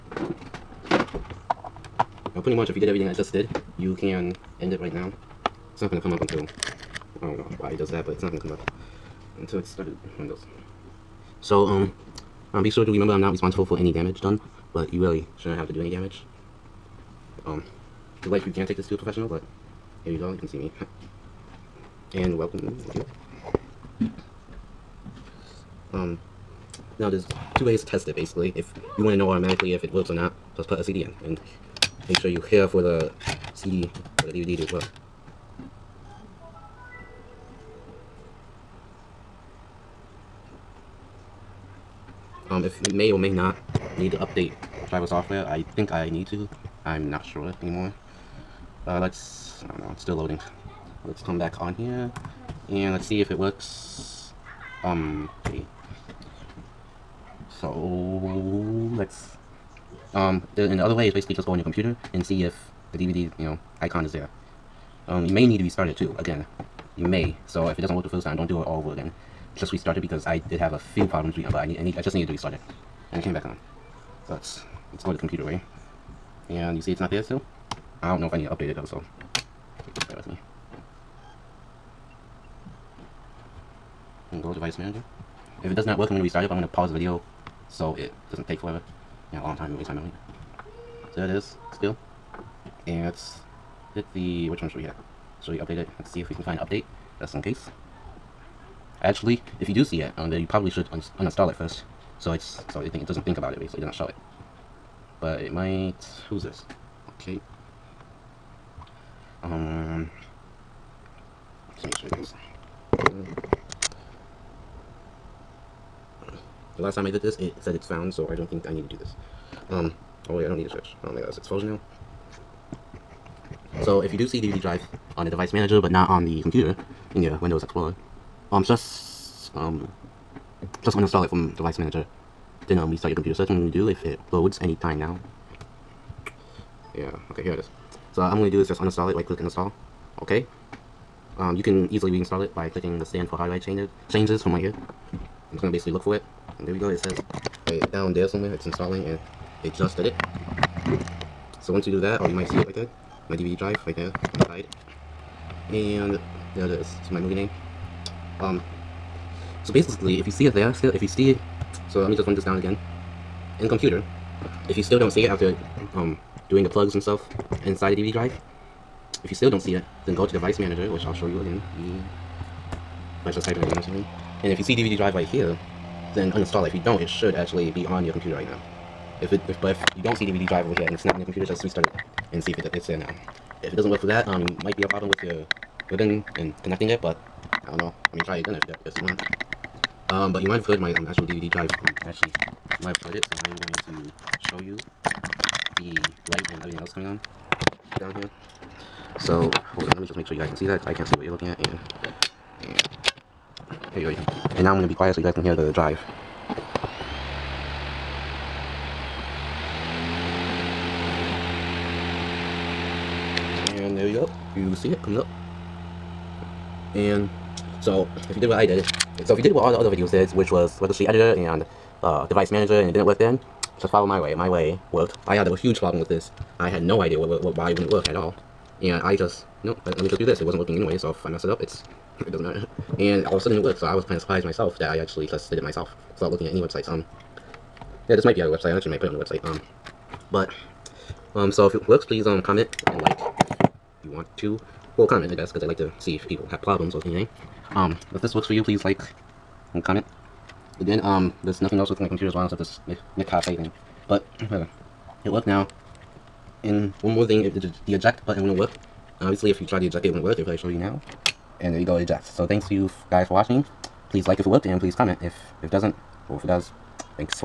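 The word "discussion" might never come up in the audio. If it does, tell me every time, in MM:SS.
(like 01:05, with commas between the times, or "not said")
not said.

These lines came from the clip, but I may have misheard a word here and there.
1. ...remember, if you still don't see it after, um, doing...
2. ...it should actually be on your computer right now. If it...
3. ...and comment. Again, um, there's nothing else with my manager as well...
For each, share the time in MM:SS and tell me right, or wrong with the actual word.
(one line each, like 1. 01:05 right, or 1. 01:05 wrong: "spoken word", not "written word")
1. 02:43 wrong: "computer", not "remember"
2. 02:57 right
3. 04:09 wrong: "computer", not "manager".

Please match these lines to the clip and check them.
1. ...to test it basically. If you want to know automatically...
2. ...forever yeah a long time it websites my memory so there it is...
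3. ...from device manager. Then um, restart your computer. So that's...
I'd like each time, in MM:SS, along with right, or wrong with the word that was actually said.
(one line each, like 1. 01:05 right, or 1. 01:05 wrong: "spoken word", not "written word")
1. 00:27 right
2. 01:28 wrong: "wastes", not "websites"
3. 02:11 right.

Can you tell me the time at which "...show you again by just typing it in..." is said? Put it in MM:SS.
02:51.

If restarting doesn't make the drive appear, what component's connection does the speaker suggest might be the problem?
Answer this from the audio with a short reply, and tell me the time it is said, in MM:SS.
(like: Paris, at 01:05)
Ribbon, at 03:05.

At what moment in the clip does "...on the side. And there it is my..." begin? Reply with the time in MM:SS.
02:34.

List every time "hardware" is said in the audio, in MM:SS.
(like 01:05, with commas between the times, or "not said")
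02:23.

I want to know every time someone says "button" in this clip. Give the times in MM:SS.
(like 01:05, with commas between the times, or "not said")
04:18.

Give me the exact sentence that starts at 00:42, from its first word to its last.
um, if it may or may not need to update driver software.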